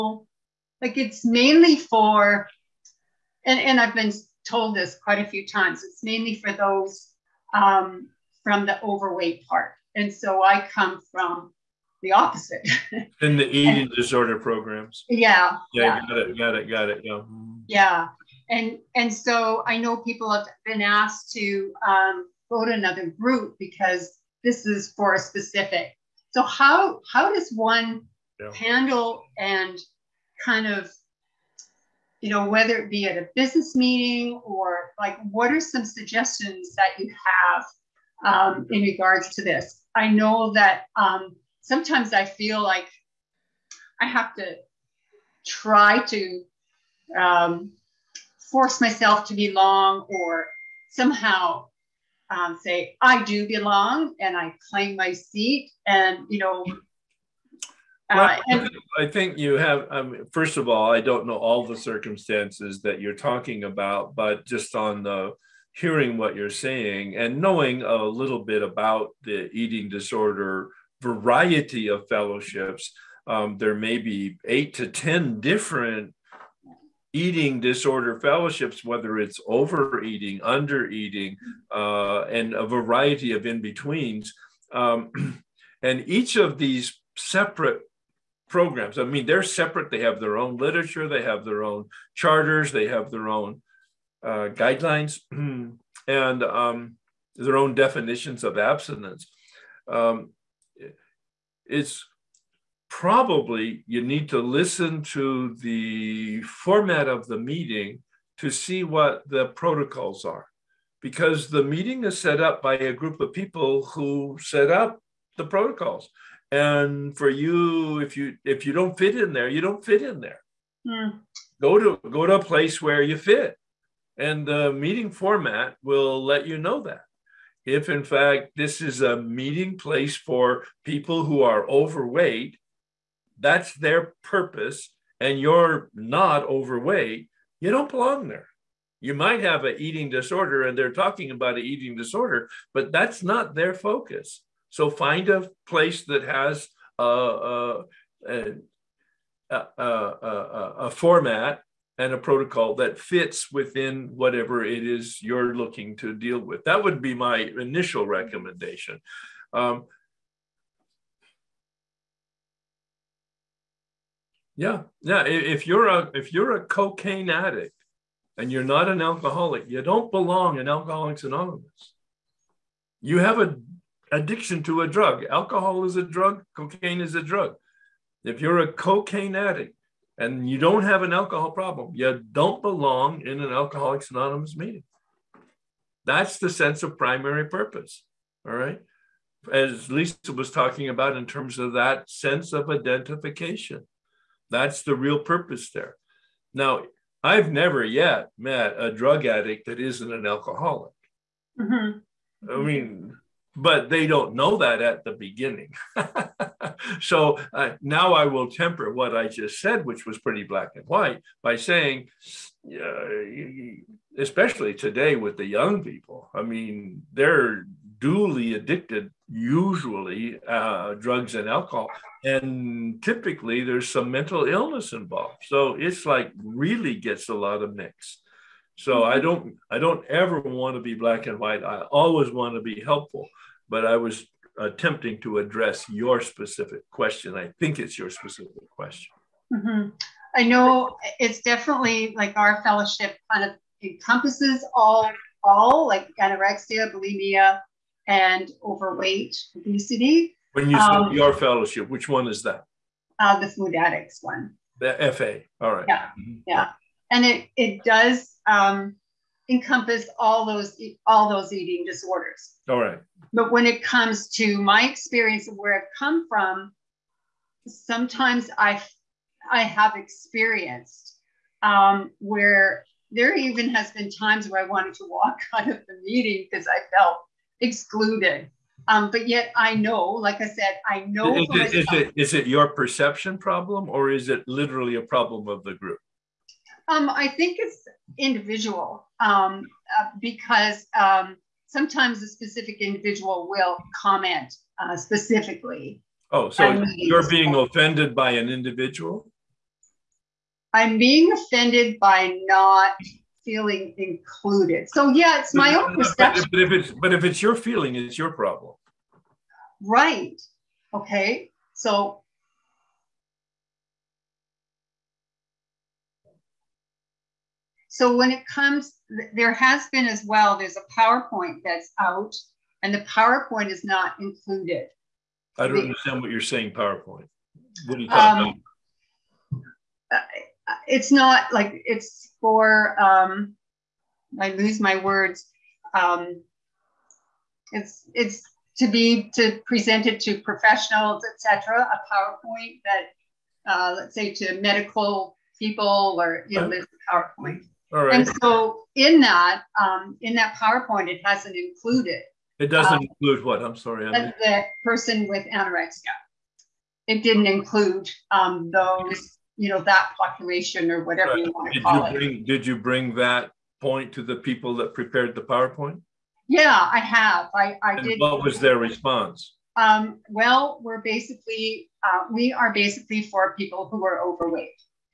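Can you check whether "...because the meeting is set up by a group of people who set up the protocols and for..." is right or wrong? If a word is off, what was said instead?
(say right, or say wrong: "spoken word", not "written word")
right.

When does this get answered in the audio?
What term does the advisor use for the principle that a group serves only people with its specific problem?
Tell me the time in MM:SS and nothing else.
03:06.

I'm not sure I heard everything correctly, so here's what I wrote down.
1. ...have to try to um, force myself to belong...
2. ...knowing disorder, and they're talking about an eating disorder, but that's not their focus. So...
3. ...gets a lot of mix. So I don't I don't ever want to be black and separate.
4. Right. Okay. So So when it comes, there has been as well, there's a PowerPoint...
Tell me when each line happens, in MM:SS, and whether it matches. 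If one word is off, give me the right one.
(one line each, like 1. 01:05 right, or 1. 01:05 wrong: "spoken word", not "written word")
1. 00:44 right
2. 02:19 wrong: "eating", not "knowing"
3. 03:46 wrong: "white", not "separate"
4. 05:09 right.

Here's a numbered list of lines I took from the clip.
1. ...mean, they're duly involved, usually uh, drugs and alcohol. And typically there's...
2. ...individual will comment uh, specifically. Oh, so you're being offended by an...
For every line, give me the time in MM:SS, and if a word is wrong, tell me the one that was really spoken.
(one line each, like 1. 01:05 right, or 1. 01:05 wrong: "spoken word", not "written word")
1. 03:36 wrong: "addicted", not "involved"
2. 04:52 right.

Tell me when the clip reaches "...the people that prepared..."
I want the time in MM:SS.
06:04.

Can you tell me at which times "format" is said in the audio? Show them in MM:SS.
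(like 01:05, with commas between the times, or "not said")
01:46, 02:05, 02:30.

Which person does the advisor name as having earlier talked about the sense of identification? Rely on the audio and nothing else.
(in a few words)
Lisa.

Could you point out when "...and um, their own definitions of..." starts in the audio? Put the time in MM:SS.
01:36.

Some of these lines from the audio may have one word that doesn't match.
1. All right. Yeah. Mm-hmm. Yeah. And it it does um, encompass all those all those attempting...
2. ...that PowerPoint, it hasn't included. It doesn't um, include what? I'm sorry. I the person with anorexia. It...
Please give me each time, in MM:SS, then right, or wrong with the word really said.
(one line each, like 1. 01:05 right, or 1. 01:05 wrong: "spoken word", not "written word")
1. 04:15 wrong: "eating", not "attempting"
2. 05:50 right.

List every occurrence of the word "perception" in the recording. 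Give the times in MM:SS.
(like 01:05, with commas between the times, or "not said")
04:42, 05:05.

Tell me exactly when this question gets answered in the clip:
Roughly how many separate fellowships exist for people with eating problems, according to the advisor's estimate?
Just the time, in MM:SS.
01:14.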